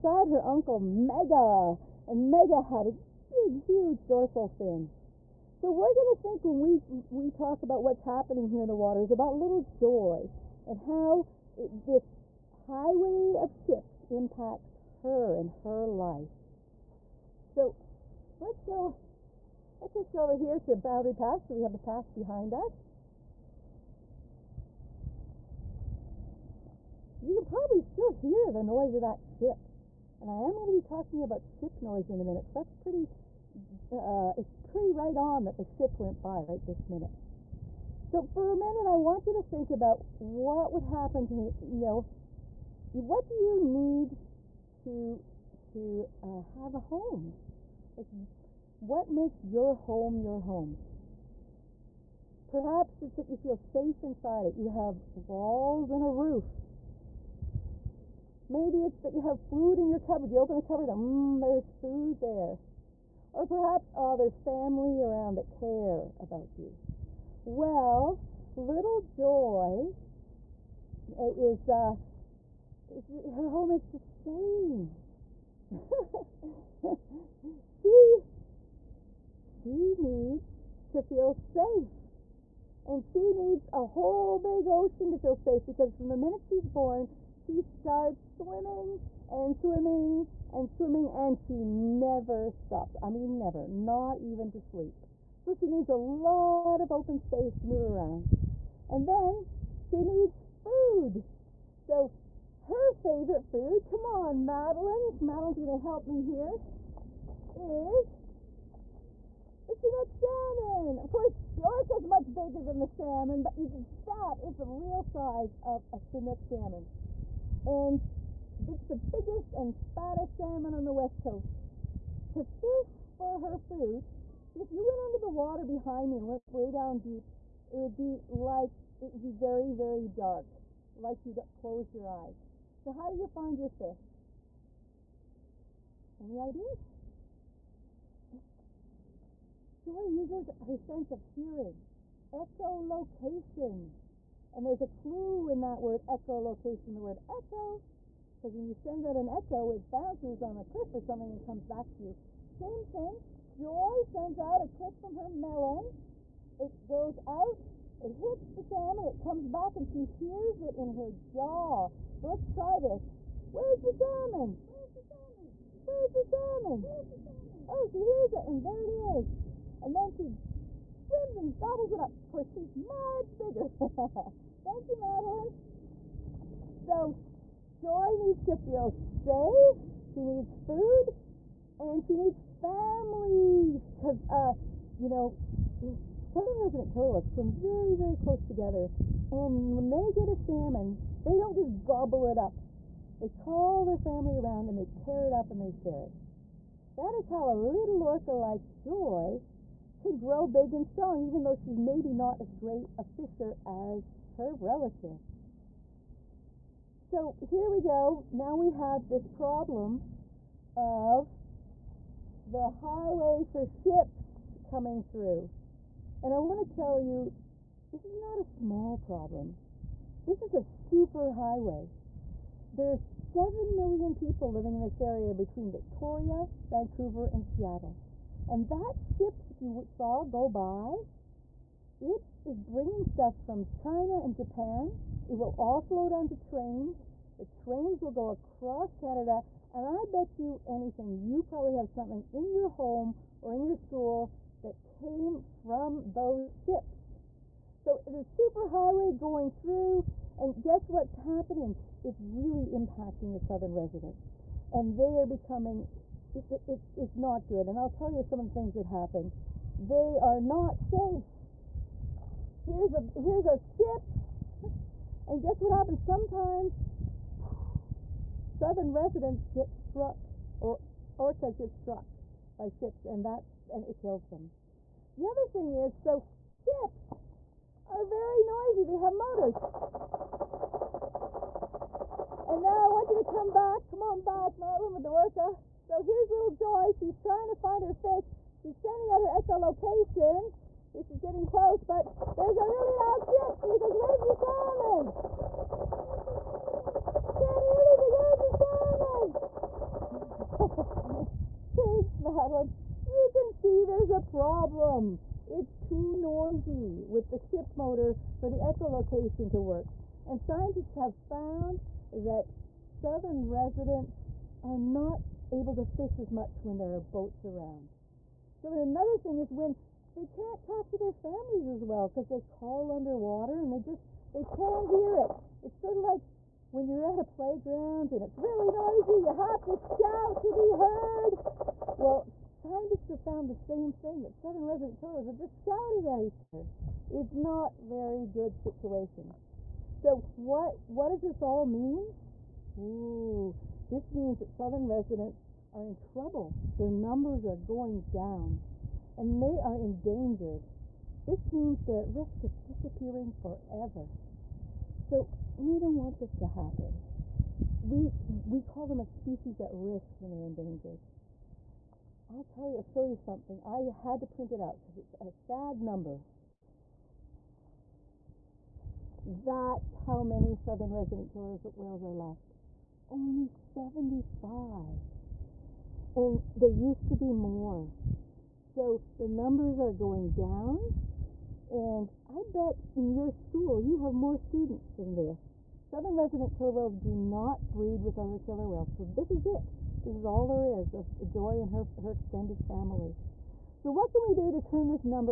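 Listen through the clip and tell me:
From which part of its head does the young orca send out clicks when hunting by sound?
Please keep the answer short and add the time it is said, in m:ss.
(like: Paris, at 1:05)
Her melon, at 2:35.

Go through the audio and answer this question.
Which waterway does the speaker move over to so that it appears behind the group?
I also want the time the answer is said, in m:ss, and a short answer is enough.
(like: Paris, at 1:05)
Boundary Pass, at 0:20.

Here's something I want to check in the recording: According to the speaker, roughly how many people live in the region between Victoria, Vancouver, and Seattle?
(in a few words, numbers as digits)
7 million.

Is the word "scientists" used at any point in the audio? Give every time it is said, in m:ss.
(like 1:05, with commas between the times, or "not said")
5:10, 5:32.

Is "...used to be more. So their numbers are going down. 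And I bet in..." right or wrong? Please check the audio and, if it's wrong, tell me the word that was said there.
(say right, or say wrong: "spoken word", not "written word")
right.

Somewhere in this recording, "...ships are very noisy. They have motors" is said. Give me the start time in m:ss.
4:36.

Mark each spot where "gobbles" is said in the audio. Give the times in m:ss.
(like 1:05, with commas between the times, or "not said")
2:51, 3:11.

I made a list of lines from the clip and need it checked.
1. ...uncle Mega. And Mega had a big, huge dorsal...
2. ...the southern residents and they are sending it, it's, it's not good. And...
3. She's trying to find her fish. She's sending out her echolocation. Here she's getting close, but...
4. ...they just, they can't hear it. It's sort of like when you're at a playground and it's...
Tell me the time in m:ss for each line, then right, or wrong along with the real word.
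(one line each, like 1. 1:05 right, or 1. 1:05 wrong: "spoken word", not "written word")
1. 0:00 right
2. 4:13 wrong: "becoming", not "sending"
3. 4:46 right
4. 5:23 right.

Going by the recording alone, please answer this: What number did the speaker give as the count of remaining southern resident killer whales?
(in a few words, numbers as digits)
75.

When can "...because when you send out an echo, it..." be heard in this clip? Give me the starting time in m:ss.
2:28.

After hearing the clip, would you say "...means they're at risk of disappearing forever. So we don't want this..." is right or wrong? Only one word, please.
right.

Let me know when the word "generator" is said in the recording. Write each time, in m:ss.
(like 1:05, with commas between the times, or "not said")
not said.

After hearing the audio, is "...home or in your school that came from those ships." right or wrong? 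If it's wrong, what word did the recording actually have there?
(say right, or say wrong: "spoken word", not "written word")
right.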